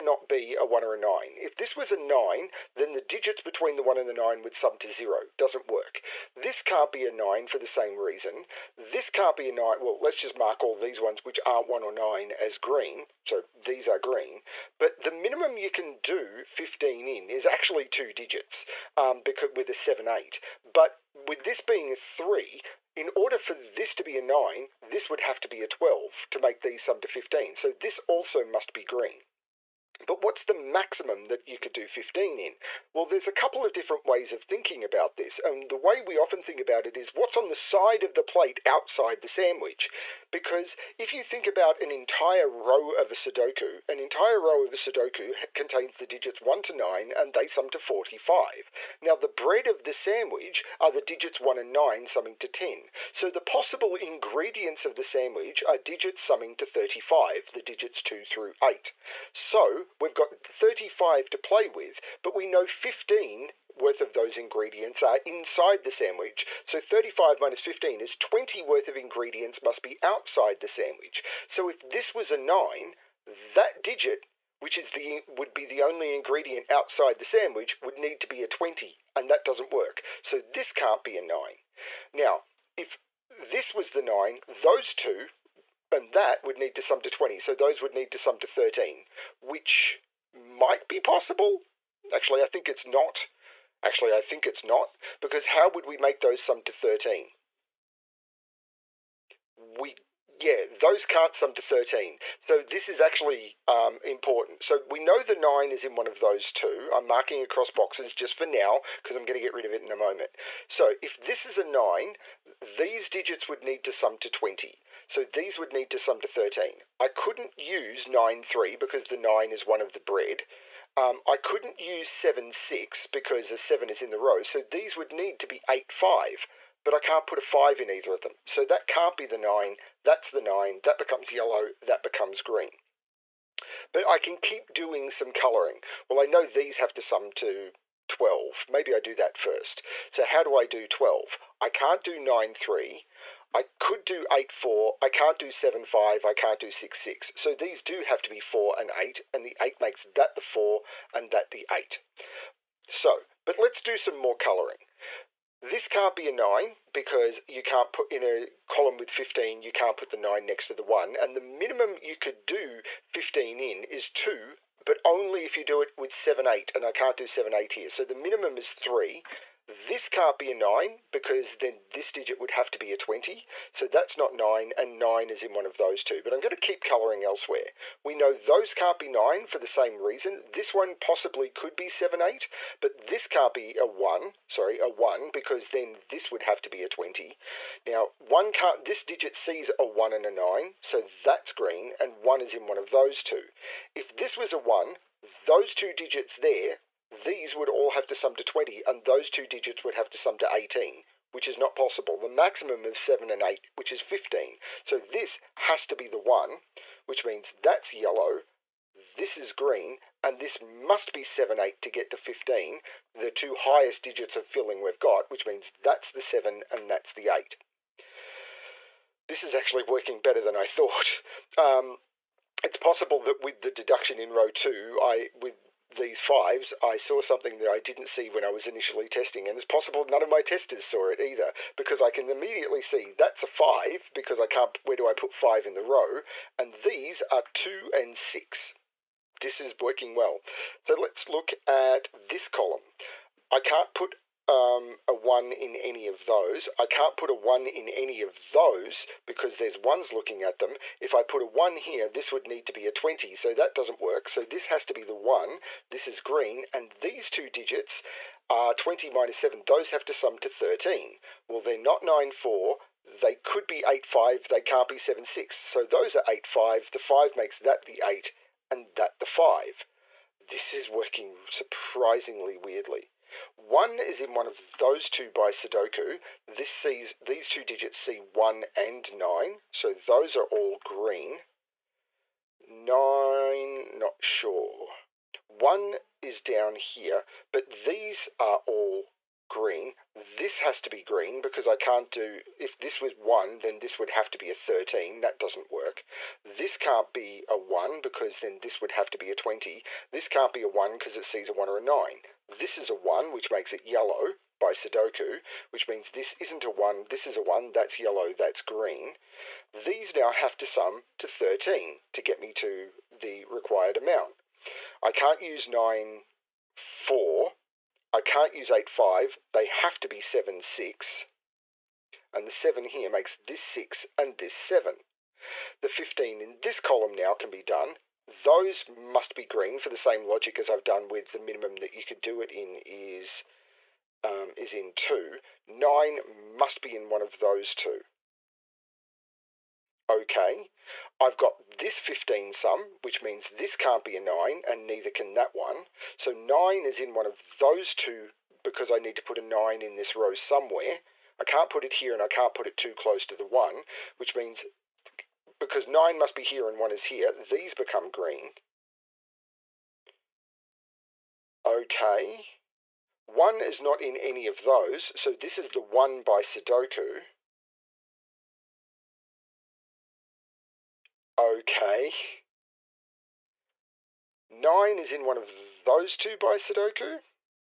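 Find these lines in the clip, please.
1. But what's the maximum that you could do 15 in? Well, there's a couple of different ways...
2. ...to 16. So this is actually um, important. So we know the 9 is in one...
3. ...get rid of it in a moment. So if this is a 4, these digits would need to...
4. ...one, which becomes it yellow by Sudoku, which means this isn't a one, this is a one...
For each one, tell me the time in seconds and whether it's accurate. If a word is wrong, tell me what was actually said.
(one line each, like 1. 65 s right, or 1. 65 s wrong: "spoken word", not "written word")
1. 30 s right
2. 101 s wrong: "13", not "16"
3. 109 s wrong: "9", not "4"
4. 302 s wrong: "makes", not "becomes".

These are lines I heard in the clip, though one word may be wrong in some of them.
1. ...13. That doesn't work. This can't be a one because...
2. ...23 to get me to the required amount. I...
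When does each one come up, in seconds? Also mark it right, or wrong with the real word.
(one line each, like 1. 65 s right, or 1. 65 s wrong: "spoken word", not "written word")
1. 294 s right
2. 311 s wrong: "13", not "23".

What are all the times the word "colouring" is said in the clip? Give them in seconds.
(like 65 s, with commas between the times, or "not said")
135 s, 154 s, 176 s.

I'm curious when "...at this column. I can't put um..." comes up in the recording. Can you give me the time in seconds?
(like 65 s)
241 s.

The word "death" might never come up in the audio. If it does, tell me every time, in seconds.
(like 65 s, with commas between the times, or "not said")
not said.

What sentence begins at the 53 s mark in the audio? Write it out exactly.
So the possible ingredients of the sandwich are digits summing to 35, the digits 2 through 8.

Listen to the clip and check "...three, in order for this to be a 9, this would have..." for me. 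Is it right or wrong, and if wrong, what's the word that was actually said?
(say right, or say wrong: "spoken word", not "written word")
right.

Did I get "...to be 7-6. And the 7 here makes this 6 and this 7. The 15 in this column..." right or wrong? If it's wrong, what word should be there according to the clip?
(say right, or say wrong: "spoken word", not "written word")
right.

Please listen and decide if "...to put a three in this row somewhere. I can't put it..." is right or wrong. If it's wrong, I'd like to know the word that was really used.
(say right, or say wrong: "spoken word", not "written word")
wrong: "nine", not "three".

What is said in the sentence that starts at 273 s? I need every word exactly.
One is in one of those two by Sudoku.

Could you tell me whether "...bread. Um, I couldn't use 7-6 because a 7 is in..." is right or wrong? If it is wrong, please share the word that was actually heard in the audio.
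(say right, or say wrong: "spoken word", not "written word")
right.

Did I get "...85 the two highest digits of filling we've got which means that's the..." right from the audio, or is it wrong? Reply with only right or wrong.
wrong.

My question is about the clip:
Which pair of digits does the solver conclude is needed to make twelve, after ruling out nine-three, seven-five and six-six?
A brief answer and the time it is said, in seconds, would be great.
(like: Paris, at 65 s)
4 and 8, at 148 s.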